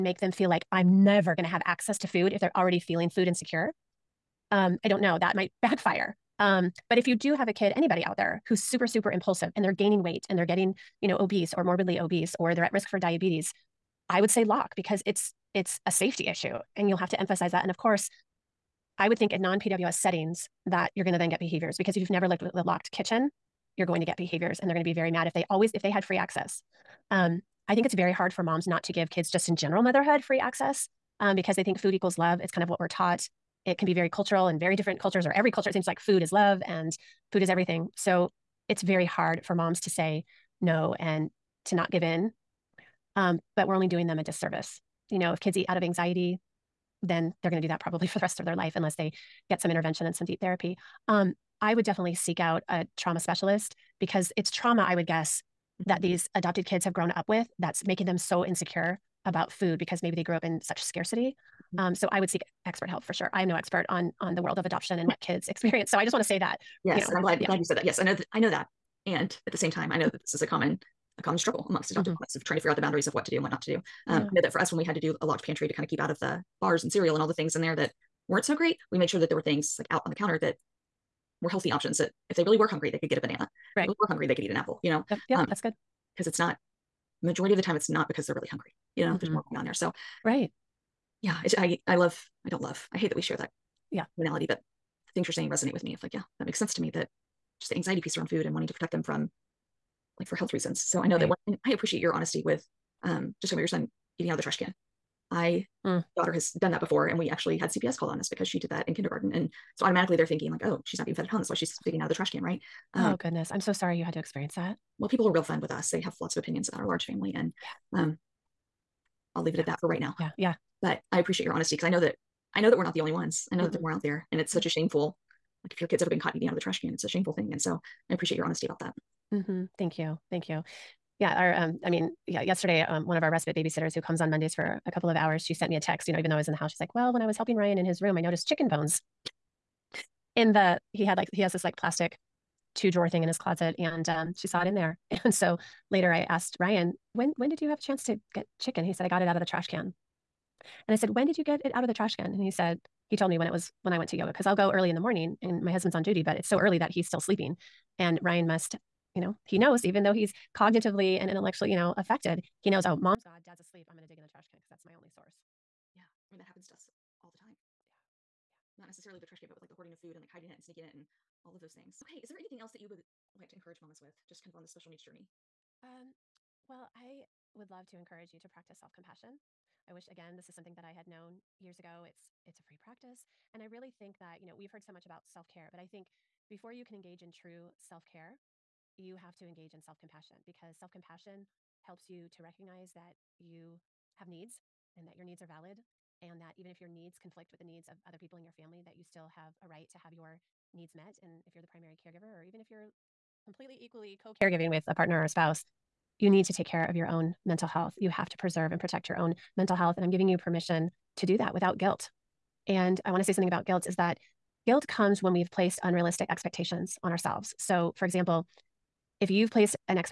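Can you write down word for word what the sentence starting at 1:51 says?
That's why she's digging out of the trash can, right?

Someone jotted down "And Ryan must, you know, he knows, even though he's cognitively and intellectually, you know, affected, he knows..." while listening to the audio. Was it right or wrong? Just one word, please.
right.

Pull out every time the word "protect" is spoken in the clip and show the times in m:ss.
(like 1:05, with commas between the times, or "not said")
1:38, 3:28.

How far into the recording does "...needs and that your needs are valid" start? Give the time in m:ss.
3:14.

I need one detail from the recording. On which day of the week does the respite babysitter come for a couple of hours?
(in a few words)
Mondays.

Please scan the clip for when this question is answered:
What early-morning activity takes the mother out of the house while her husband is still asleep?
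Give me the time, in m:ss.
2:34.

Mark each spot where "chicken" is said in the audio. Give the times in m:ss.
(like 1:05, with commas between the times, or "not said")
2:18, 2:28.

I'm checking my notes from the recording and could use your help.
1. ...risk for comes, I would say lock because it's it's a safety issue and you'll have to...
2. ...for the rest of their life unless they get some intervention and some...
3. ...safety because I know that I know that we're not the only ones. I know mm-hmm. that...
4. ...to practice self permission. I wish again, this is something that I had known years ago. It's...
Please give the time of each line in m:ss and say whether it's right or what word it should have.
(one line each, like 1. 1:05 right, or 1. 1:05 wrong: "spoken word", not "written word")
1. 0:12 wrong: "diabetes", not "comes"
2. 0:48 right
3. 2:01 wrong: "honesty", not "safety"
4. 2:58 wrong: "compassion", not "permission".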